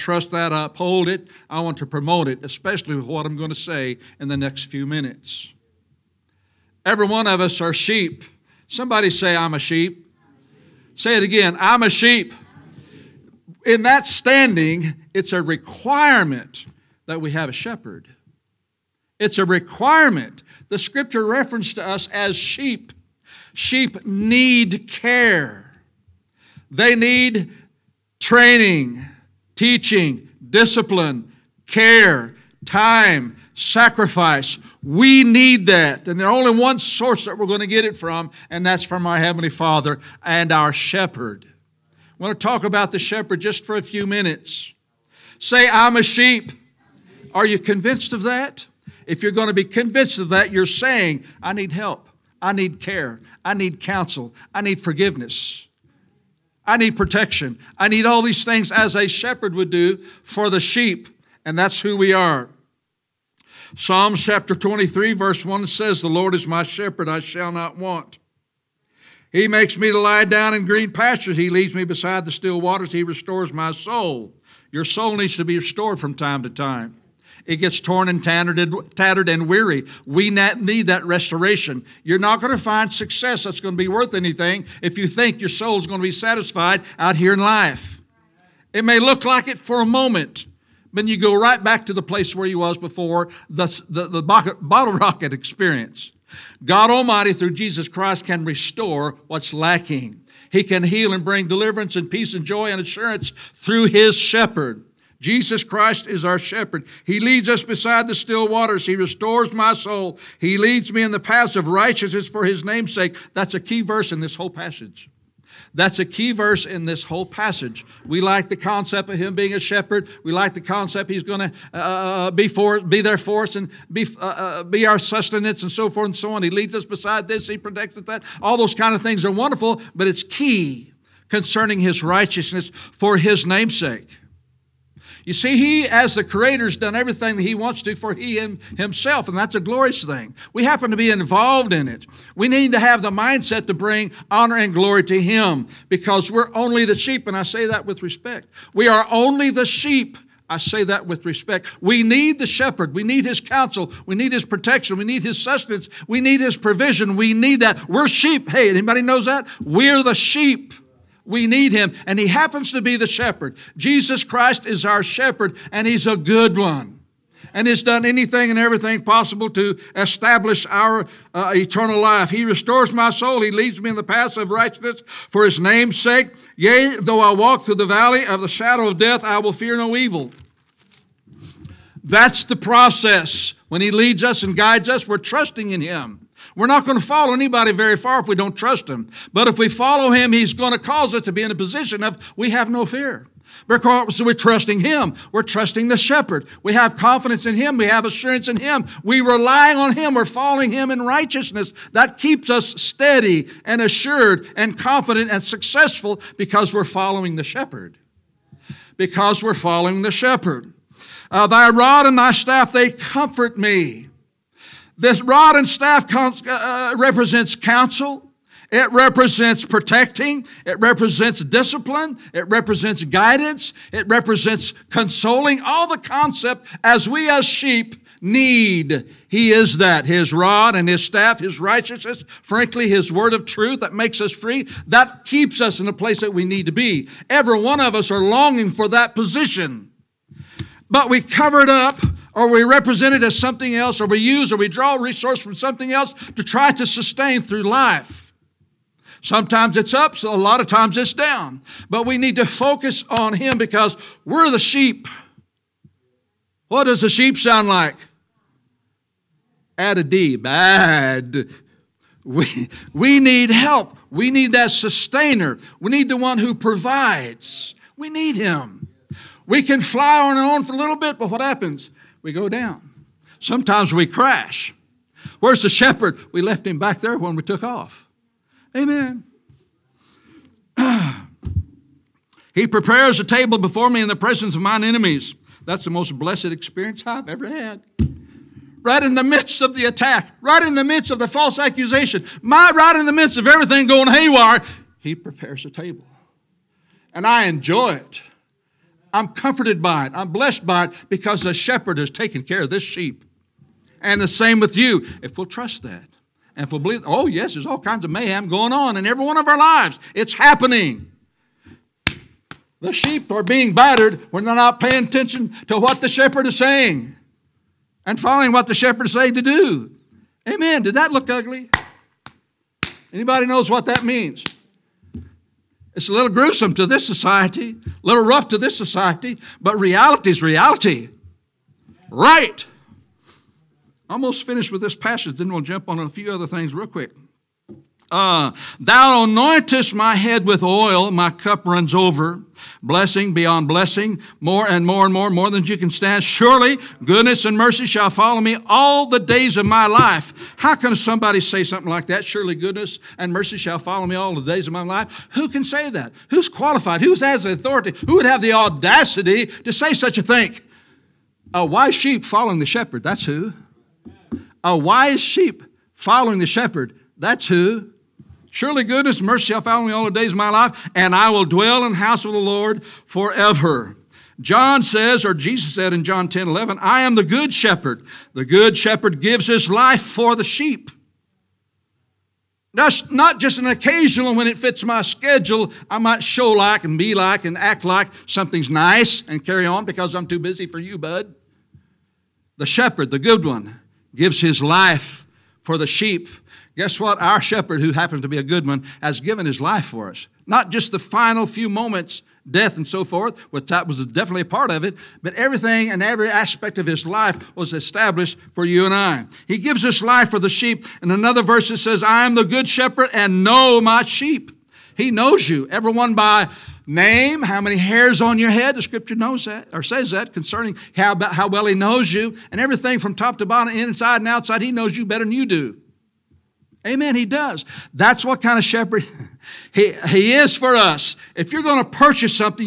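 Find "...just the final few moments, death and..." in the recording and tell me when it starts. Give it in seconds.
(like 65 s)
400 s.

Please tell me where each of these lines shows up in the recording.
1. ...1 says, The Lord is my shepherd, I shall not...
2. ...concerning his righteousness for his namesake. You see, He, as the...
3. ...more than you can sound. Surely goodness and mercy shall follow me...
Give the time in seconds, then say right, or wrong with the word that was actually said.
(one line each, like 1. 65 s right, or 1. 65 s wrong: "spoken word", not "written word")
1. 65 s right
2. 131 s right
3. 345 s wrong: "stand", not "sound".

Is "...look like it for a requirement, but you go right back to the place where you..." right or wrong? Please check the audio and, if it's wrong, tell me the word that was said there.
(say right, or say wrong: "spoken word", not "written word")
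wrong: "moment", not "requirement".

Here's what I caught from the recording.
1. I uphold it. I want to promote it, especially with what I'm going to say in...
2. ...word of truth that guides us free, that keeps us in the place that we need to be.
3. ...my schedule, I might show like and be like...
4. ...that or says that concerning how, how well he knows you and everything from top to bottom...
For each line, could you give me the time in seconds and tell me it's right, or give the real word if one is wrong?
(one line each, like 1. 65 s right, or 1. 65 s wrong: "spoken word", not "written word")
1. 0 s right
2. 233 s wrong: "makes", not "guides"
3. 384 s right
4. 419 s right.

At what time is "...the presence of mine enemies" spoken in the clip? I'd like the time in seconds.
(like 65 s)
284 s.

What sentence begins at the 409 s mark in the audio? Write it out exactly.
He gives us life for the sheep.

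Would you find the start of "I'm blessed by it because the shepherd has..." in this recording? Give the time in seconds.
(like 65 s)
300 s.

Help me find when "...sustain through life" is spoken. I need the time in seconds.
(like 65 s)
246 s.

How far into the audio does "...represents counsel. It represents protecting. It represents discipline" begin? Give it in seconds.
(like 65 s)
216 s.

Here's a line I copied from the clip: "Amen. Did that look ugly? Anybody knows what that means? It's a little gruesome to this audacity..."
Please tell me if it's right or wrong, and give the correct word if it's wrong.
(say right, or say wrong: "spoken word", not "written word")
wrong: "society", not "audacity".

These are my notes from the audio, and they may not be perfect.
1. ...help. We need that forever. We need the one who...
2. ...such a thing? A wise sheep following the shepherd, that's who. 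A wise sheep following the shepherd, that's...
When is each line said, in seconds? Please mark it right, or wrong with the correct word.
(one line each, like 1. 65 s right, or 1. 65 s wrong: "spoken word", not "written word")
1. 263 s wrong: "sustainer", not "forever"
2. 359 s right.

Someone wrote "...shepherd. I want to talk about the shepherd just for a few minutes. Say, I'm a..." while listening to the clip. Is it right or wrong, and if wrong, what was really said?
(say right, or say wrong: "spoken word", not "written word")
right.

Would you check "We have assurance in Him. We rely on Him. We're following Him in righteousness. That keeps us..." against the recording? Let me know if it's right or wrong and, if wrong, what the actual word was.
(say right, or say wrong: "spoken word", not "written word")
right.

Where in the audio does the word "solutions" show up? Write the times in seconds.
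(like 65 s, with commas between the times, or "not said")
not said.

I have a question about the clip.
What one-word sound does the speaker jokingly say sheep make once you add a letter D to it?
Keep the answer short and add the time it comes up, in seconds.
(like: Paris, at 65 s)
bad, at 260 s.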